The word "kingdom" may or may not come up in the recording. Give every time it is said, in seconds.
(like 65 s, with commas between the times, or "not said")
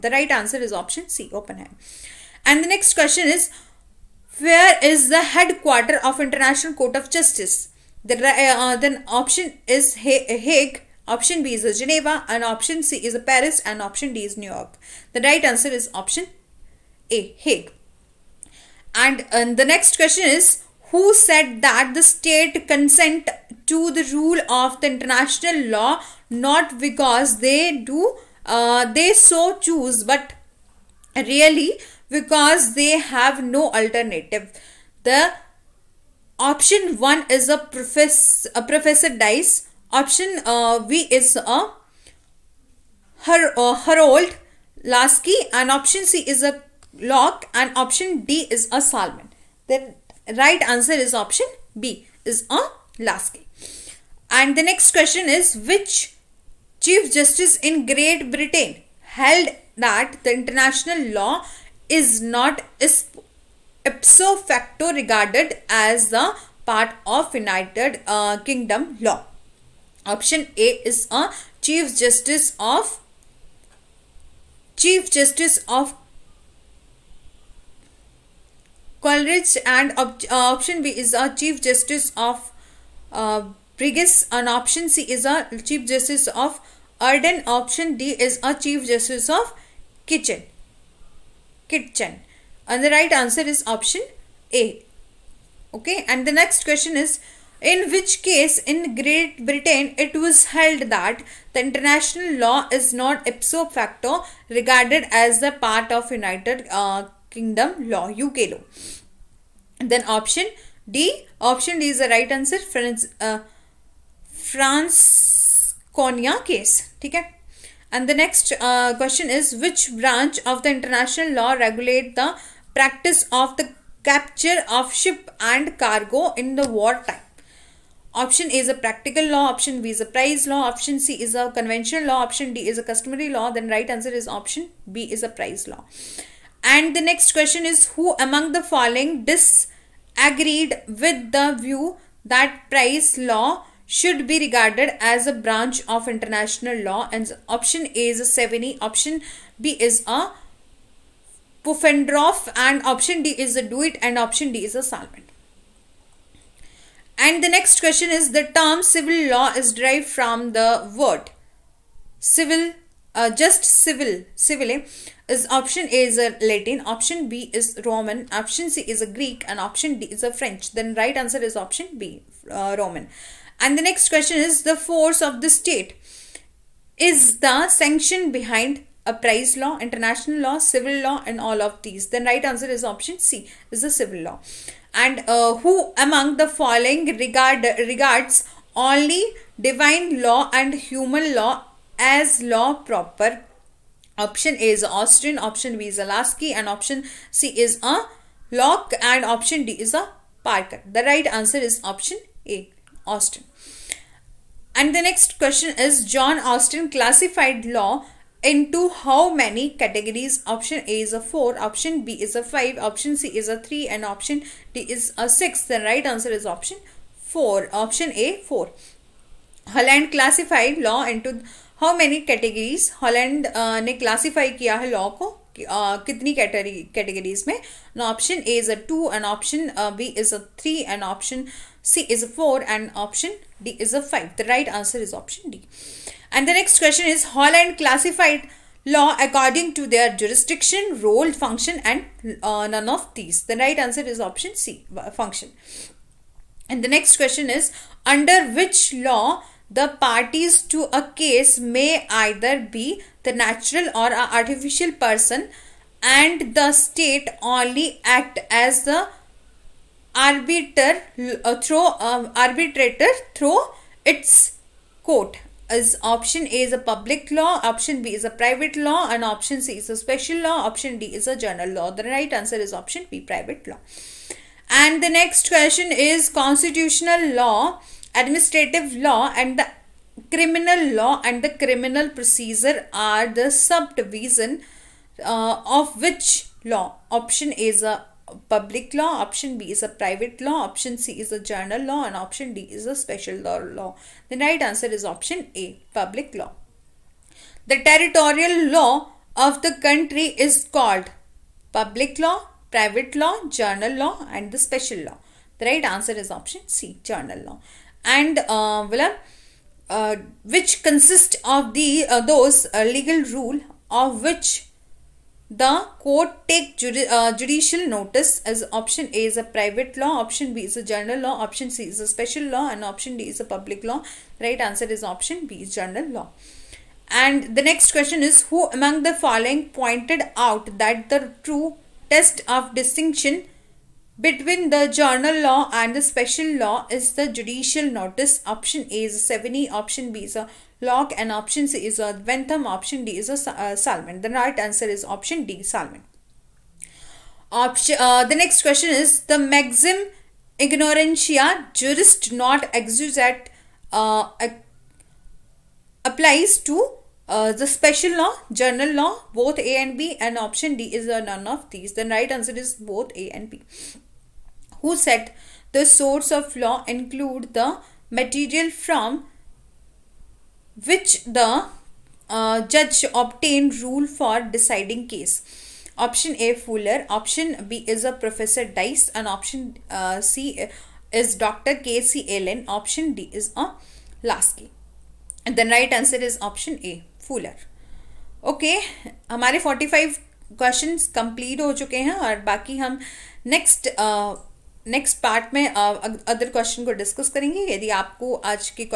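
68 s, 107 s.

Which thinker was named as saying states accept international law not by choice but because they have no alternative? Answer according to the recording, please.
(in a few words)
Harold Laski.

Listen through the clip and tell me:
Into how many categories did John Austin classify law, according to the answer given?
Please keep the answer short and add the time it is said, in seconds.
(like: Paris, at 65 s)
4, at 217 s.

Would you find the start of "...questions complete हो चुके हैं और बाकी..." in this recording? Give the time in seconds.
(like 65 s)
390 s.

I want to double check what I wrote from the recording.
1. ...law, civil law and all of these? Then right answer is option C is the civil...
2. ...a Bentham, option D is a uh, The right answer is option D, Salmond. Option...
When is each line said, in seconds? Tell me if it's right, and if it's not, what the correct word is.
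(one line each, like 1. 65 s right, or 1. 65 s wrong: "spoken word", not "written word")
1. 180 s right
2. 341 s right.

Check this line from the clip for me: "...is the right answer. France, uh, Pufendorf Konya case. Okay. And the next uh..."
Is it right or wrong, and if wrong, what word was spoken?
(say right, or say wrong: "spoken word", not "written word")
wrong: "France", not "Pufendorf".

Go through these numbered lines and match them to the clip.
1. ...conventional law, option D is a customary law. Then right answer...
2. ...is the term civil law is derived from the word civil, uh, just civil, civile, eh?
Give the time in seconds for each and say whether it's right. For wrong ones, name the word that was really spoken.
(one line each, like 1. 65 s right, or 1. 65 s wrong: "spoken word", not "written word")
1. 131 s right
2. 158 s right.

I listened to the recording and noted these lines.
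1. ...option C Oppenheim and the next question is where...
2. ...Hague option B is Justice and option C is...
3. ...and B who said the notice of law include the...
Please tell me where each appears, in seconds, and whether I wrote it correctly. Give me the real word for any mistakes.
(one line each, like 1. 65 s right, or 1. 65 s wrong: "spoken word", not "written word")
1. 0 s right
2. 9 s wrong: "Geneva", not "Justice"
3. 363 s wrong: "source", not "notice".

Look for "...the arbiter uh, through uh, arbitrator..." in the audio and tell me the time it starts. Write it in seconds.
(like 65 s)
258 s.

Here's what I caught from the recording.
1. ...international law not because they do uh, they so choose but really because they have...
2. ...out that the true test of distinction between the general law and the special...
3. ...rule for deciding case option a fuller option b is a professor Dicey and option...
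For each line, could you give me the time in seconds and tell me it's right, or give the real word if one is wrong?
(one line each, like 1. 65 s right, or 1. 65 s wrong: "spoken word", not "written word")
1. 24 s right
2. 330 s right
3. 373 s right.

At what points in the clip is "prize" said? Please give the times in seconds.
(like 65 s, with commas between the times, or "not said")
130 s, 135 s, 142 s, 179 s.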